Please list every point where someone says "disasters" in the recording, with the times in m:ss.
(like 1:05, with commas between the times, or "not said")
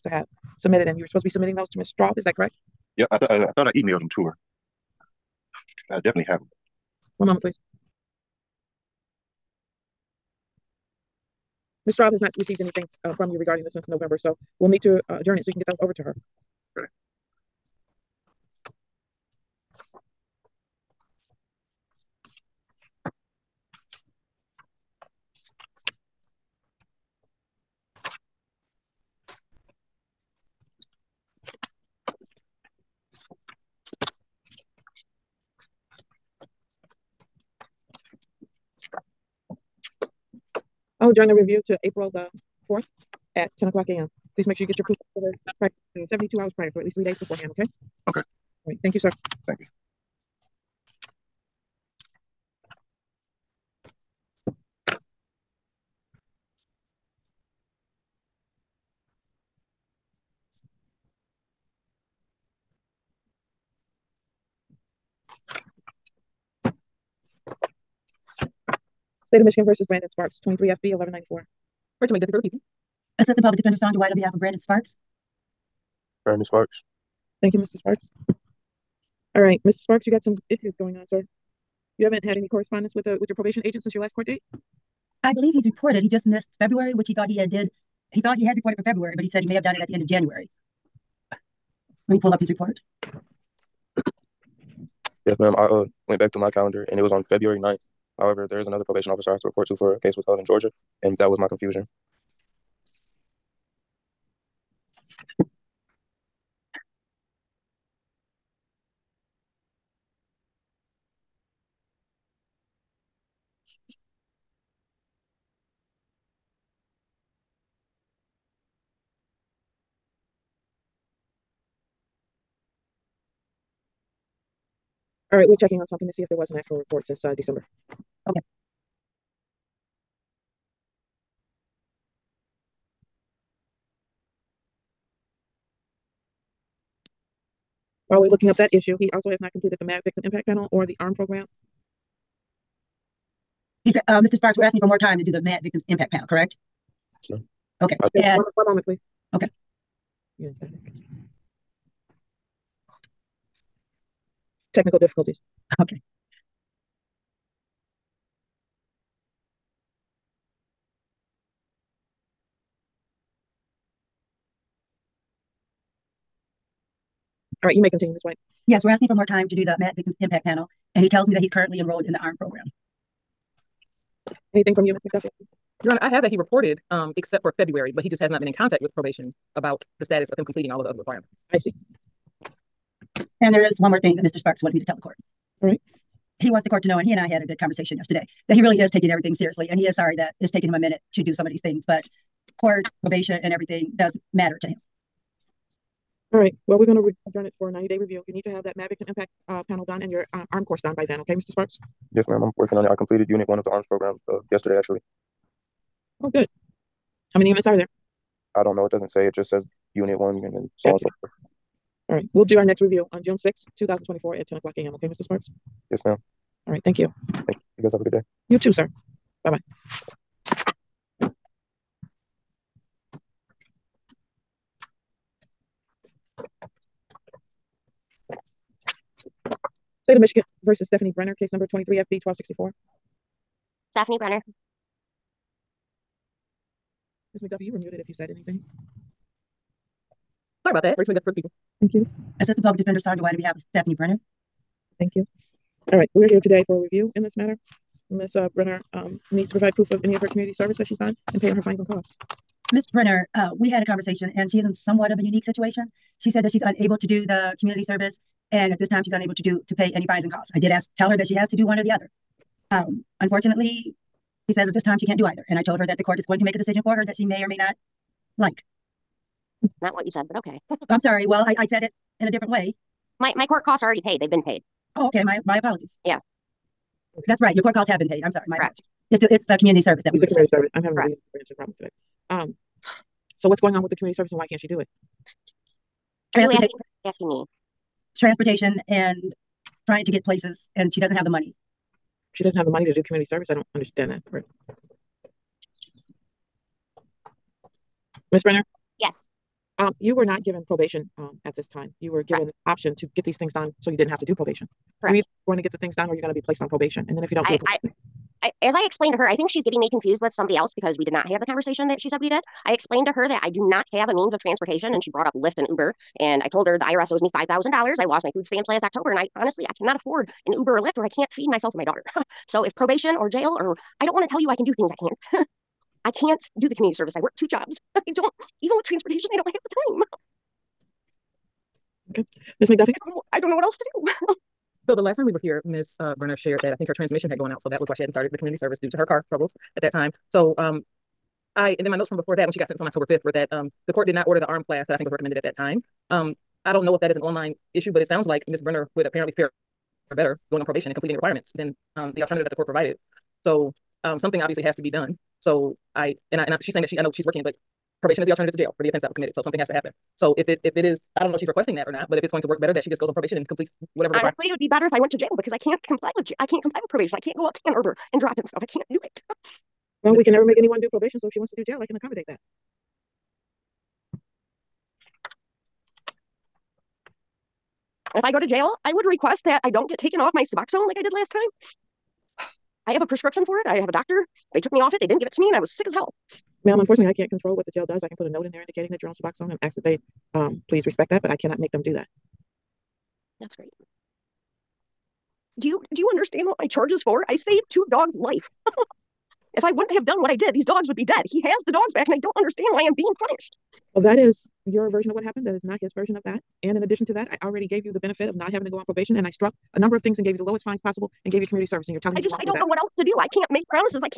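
not said.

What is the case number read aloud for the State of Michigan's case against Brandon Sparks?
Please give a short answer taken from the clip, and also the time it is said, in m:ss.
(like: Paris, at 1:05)
23 FB 1194, at 1:10.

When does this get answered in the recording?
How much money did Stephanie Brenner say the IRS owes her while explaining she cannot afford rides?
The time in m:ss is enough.
5:17.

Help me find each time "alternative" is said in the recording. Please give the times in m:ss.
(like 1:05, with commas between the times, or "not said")
5:52, 5:58.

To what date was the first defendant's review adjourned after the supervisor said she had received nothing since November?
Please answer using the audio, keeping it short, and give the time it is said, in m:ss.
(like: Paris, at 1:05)
April 4th, at 0:41.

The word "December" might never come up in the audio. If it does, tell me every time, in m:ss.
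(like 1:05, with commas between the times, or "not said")
2:07.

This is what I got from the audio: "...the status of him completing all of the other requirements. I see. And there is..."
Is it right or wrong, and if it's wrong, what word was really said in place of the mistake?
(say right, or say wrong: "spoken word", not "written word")
right.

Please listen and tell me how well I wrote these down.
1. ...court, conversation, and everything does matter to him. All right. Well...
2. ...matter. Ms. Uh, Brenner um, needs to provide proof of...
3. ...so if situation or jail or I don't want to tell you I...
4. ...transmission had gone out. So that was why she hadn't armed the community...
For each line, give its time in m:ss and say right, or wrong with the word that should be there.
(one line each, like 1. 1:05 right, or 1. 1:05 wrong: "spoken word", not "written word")
1. 3:12 wrong: "probation", not "conversation"
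2. 4:07 right
3. 5:22 wrong: "probation", not "situation"
4. 5:36 wrong: "started", not "armed".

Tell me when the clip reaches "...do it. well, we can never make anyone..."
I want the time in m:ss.
6:08.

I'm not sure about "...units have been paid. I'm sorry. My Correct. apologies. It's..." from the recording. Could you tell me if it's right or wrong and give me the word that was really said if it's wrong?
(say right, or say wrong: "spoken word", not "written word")
wrong: "costs", not "units".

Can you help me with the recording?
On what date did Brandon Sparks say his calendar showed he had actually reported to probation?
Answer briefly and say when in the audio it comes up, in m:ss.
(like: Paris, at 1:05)
February 9th, at 1:37.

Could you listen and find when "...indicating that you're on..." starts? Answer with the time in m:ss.
6:28.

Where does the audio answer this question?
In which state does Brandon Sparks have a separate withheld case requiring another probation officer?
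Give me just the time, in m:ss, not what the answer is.
1:40.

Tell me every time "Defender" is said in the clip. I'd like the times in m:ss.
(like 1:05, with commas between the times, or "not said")
1:13, 4:02.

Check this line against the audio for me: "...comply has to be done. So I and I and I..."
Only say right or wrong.
wrong.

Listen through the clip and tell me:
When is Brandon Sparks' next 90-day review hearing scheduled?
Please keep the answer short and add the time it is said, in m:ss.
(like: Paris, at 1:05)
June 6, 2024, at 3:33.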